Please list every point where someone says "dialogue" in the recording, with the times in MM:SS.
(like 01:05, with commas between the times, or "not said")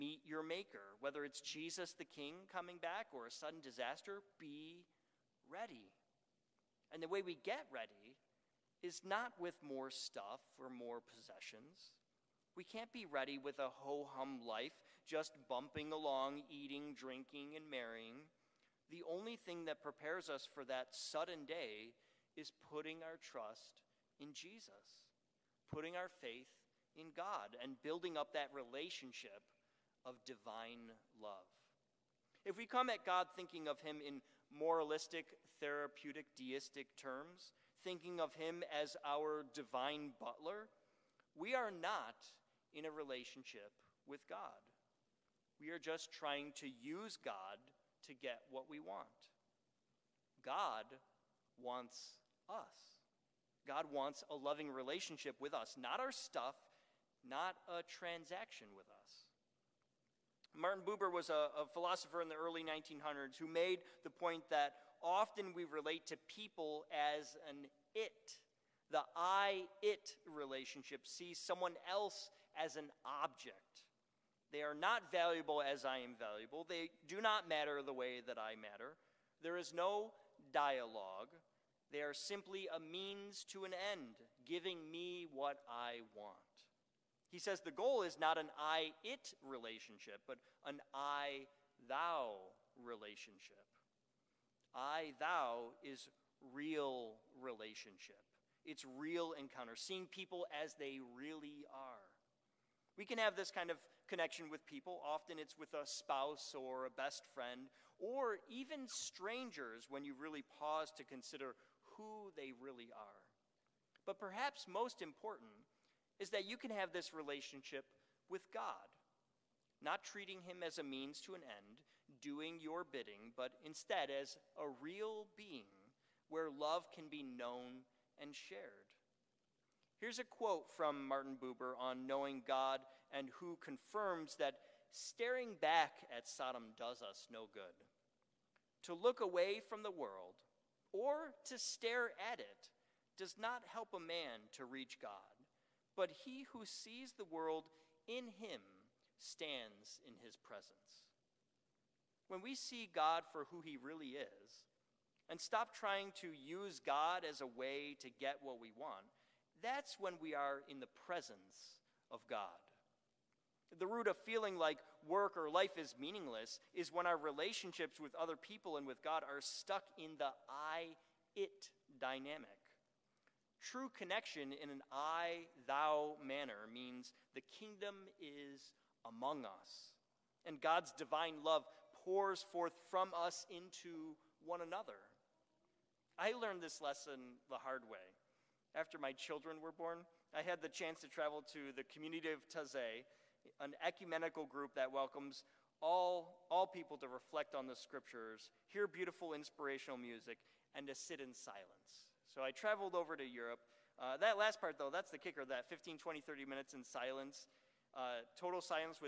01:20.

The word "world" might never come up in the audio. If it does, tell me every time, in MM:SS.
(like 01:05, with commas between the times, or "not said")
02:19, 02:27.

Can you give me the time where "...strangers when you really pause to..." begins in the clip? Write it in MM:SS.
01:48.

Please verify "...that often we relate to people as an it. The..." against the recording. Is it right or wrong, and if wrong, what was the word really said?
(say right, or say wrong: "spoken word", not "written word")
right.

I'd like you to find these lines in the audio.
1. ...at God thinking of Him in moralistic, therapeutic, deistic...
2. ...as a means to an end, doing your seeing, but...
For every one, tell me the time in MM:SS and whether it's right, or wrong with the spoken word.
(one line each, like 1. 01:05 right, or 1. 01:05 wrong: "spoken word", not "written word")
1. 00:32 right
2. 02:00 wrong: "bidding", not "seeing".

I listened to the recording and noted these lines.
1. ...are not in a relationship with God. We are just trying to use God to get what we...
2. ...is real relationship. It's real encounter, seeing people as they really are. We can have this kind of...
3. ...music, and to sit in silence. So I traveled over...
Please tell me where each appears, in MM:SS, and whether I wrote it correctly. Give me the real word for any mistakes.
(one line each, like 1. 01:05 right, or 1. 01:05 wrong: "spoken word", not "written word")
1. 00:41 right
2. 01:35 right
3. 03:19 right.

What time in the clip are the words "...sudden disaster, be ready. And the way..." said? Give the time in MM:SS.
00:03.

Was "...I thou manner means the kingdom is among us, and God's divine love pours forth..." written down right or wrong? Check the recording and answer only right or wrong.
right.